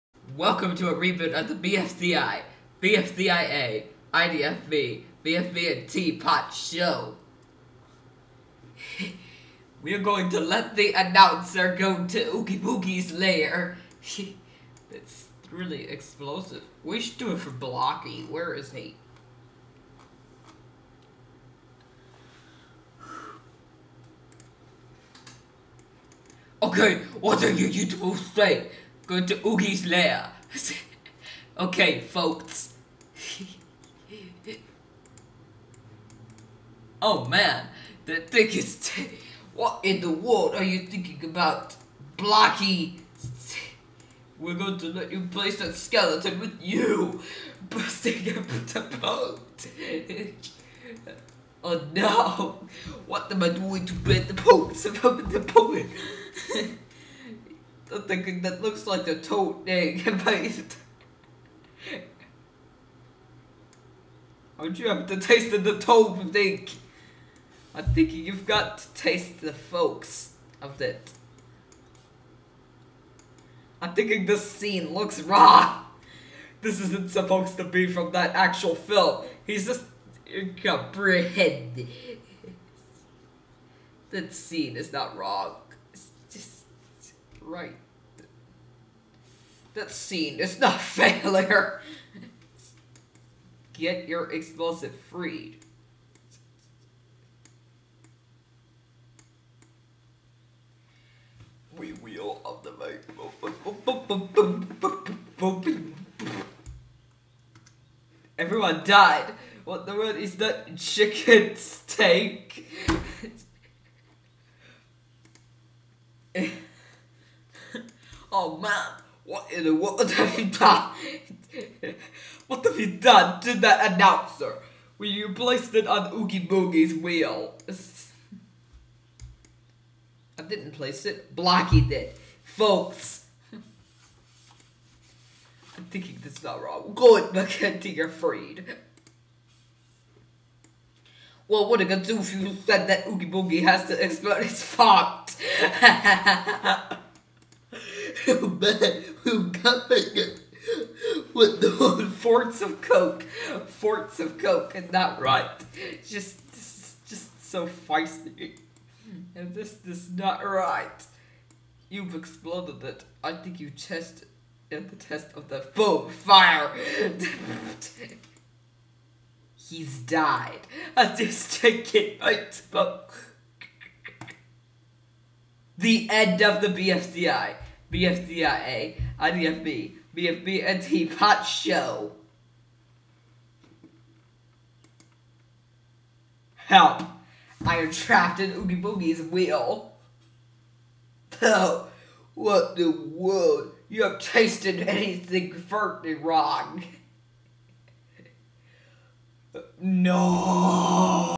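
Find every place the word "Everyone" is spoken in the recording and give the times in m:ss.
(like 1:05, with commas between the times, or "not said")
1:48.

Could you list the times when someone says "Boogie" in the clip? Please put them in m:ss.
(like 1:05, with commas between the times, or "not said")
0:12, 2:06, 2:23, 3:08.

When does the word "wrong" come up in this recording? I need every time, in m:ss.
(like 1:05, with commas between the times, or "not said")
1:25, 2:16, 3:16.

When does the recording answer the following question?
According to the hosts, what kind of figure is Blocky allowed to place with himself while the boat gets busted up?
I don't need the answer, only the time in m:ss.
0:45.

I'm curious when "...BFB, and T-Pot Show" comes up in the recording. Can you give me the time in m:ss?
3:00.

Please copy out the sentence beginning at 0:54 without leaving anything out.
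the boat thinking that looks like a tote egg and paste.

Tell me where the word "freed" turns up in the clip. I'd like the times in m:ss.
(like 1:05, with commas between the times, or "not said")
1:35, 2:18.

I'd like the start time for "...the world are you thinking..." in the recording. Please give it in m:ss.
0:39.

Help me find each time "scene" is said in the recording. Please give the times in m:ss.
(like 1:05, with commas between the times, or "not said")
1:14, 1:24, 1:29.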